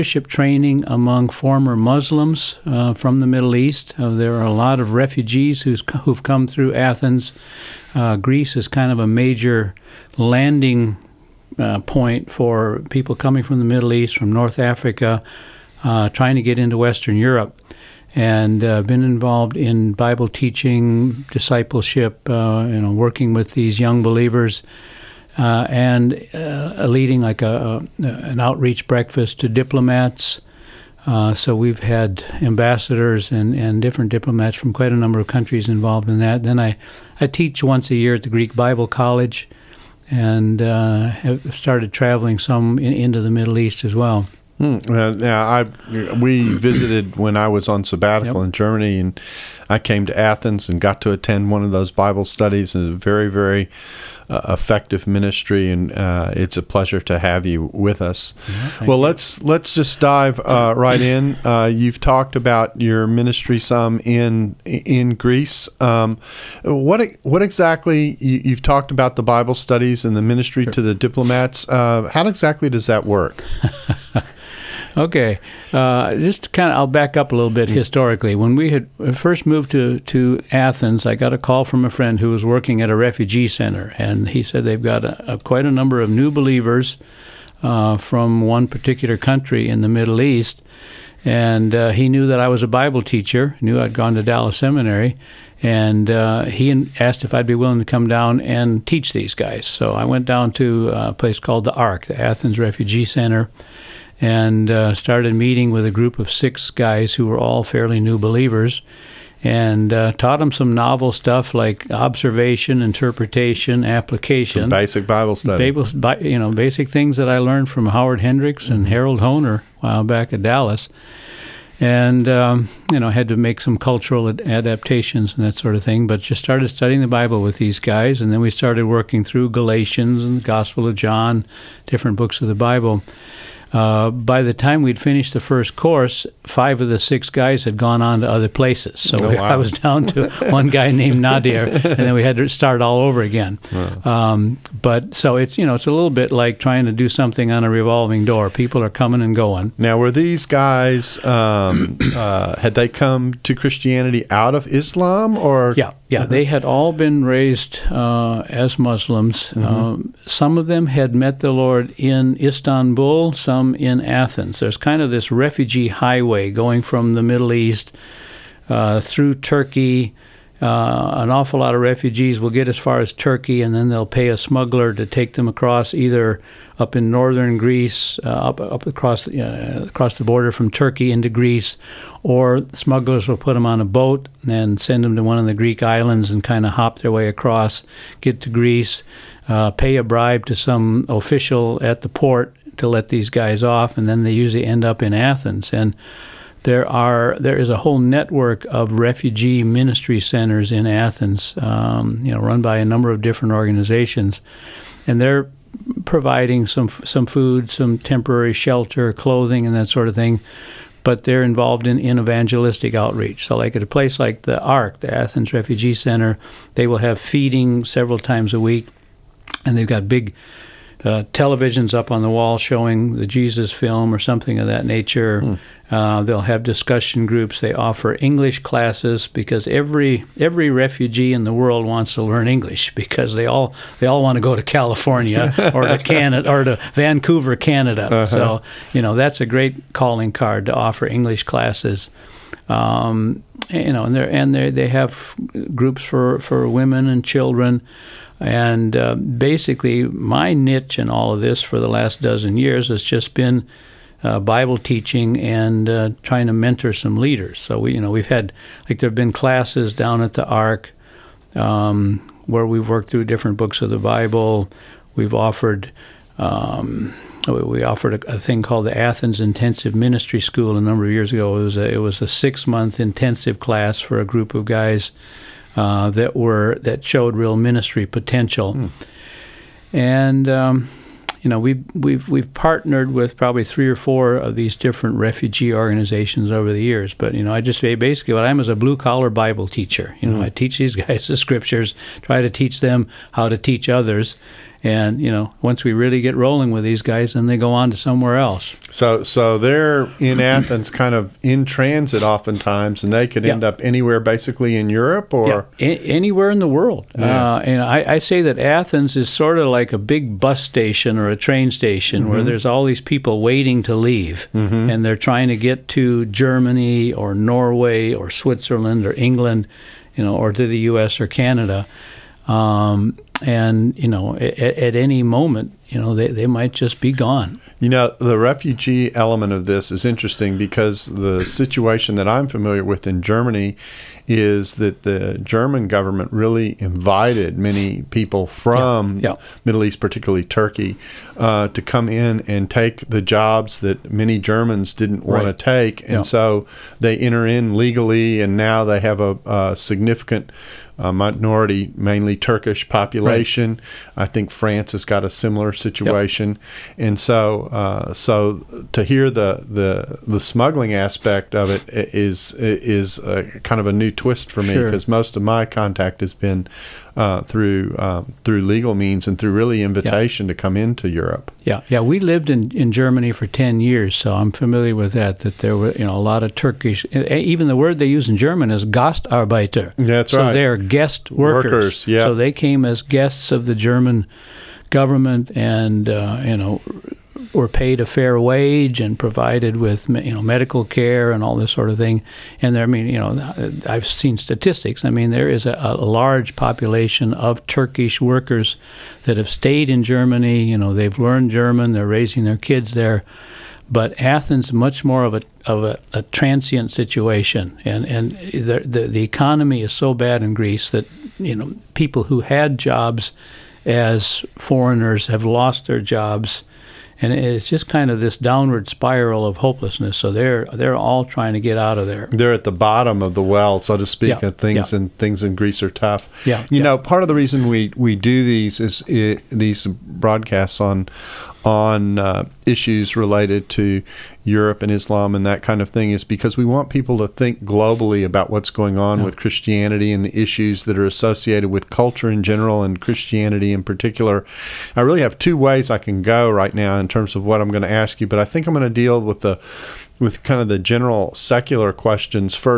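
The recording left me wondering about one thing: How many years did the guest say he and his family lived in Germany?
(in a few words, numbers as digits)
10 years.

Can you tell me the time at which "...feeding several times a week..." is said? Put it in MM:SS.
03:37.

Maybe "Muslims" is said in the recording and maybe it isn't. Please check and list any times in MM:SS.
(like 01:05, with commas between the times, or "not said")
00:01, 02:38.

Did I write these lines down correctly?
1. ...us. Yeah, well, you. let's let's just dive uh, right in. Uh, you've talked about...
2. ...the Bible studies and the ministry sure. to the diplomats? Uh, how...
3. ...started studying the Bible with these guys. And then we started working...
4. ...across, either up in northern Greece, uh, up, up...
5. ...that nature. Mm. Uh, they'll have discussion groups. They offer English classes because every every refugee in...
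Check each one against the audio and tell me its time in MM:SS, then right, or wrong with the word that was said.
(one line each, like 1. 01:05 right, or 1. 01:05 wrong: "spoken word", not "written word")
1. 00:58 right
2. 01:09 right
3. 02:06 right
4. 02:55 right
5. 03:44 right.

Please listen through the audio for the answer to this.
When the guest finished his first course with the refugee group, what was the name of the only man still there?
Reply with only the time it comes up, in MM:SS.
02:21.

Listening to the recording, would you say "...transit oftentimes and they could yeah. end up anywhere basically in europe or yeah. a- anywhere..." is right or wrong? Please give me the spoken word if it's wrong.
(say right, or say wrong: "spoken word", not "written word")
right.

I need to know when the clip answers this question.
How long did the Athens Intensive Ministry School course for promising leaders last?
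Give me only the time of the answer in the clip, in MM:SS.
04:32.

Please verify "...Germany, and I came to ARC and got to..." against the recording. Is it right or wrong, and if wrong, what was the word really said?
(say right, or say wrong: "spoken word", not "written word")
wrong: "Athens", not "ARC".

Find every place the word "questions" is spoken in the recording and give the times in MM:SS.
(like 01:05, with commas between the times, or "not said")
07:31.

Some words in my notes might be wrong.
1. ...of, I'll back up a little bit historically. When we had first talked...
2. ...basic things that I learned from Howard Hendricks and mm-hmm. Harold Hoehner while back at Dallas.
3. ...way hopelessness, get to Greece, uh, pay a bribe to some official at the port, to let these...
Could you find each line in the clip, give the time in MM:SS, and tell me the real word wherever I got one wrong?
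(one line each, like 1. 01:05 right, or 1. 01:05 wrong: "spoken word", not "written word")
1. 01:16 wrong: "moved", not "talked"
2. 01:56 right
3. 03:07 wrong: "across", not "hopelessness".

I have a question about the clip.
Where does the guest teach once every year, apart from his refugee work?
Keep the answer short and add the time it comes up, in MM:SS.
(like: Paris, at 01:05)
Greek Bible College, at 00:38.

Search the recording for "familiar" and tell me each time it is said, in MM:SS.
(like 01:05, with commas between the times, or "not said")
05:32, 06:14.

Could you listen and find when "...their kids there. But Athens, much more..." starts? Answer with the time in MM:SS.
06:42.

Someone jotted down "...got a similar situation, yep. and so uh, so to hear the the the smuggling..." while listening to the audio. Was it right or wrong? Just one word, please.
right.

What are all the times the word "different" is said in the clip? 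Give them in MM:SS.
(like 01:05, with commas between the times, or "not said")
00:33, 02:11, 03:23, 04:23, 04:44.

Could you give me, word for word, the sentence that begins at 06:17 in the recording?
Even the word they use in German is Gastarbeiter.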